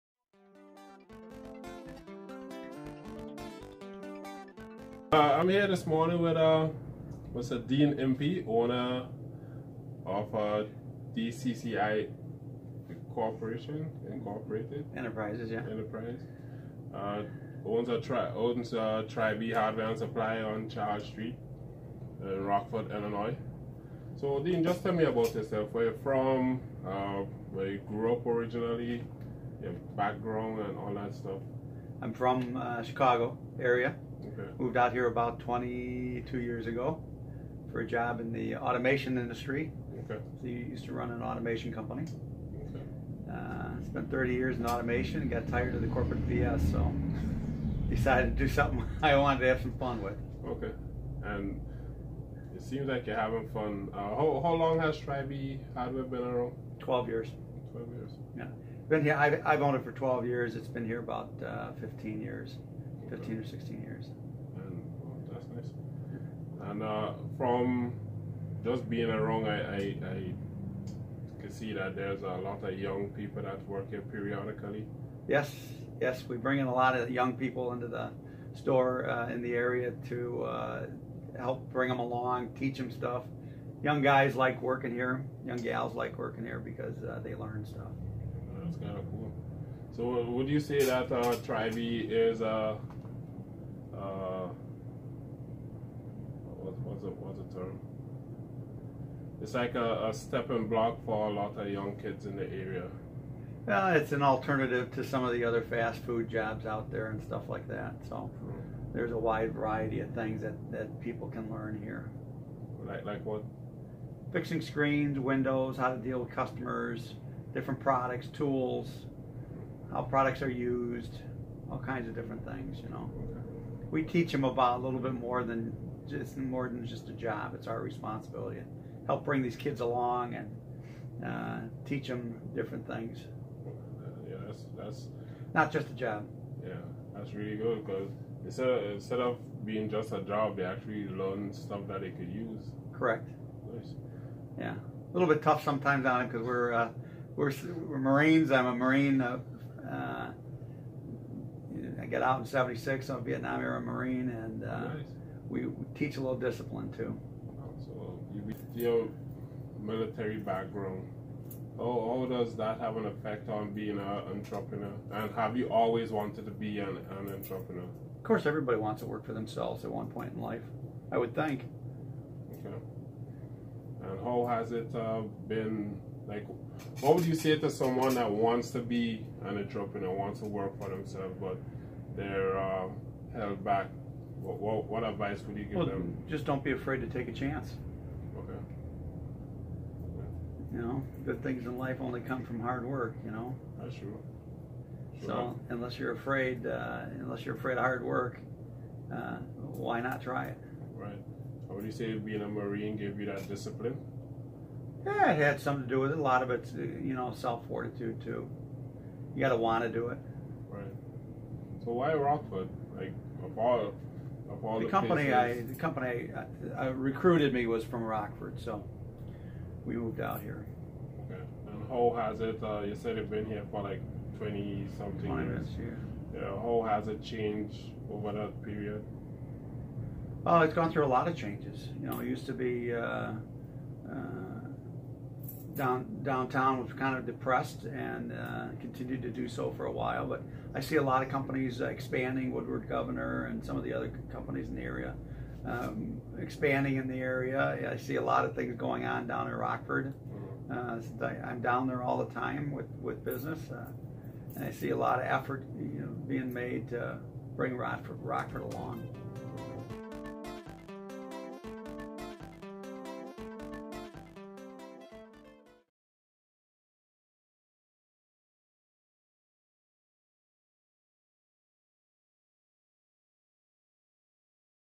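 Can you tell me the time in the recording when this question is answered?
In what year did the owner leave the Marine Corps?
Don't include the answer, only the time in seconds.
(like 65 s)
152 s.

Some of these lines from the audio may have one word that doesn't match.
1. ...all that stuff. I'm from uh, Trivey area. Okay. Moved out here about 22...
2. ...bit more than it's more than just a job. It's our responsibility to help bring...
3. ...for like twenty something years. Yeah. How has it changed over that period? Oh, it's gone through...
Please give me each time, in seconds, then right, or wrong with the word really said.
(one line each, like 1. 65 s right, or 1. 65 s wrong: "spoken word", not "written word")
1. 30 s wrong: "Chicago", not "Trivey"
2. 125 s right
3. 223 s right.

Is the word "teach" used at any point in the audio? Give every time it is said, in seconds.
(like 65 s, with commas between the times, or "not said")
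82 s, 124 s, 131 s, 156 s.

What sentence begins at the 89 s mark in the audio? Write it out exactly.
So, would you say that uh, Trivey is a uh, was a was a term.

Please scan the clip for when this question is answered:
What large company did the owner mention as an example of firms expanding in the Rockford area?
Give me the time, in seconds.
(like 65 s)
242 s.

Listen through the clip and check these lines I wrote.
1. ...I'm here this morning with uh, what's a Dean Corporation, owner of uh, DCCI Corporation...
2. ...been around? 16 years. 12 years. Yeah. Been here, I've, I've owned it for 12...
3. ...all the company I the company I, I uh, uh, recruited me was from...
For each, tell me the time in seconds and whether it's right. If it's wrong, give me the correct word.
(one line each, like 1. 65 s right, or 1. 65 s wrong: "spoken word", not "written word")
1. 5 s wrong: "Impey", not "Corporation"
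2. 56 s wrong: "12", not "16"
3. 213 s right.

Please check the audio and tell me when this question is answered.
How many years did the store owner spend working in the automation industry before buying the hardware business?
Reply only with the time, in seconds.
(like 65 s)
44 s.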